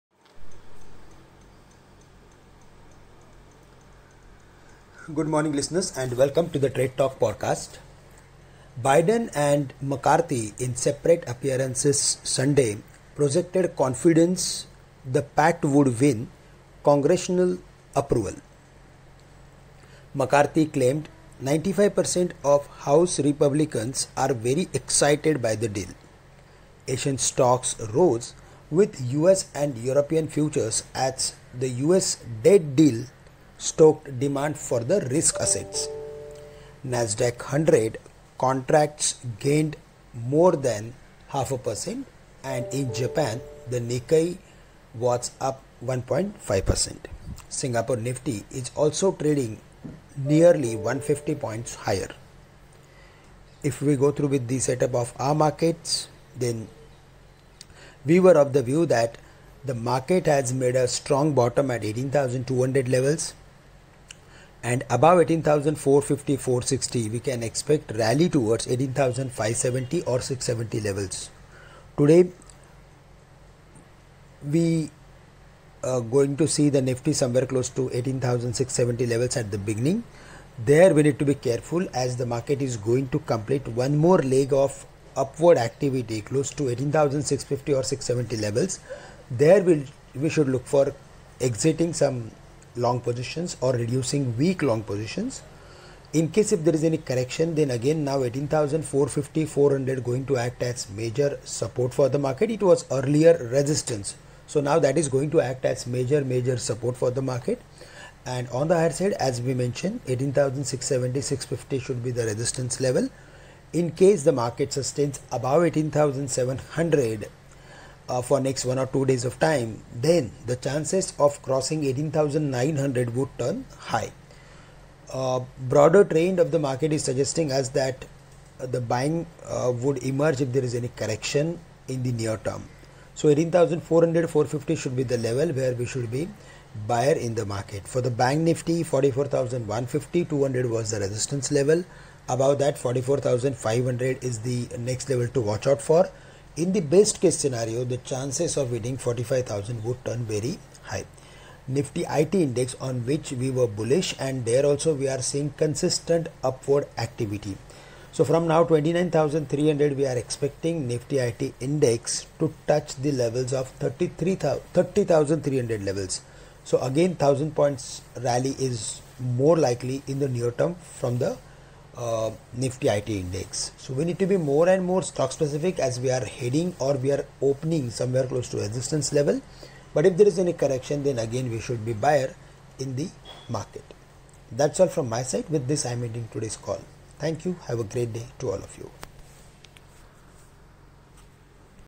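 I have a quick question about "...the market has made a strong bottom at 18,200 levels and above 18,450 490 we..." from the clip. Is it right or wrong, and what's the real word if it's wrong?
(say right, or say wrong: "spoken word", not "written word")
wrong: "460", not "490".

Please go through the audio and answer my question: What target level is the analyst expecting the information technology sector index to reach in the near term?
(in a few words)
30,300.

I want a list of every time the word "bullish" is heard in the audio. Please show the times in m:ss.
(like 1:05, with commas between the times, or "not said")
2:33.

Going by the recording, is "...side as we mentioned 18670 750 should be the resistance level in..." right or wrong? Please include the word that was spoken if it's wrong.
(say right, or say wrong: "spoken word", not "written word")
wrong: "650", not "750".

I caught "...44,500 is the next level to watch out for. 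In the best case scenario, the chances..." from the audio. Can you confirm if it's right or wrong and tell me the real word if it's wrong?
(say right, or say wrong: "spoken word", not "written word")
right.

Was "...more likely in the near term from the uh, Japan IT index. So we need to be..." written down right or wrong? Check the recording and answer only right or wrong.
wrong.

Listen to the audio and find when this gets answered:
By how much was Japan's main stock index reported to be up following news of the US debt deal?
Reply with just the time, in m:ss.
0:45.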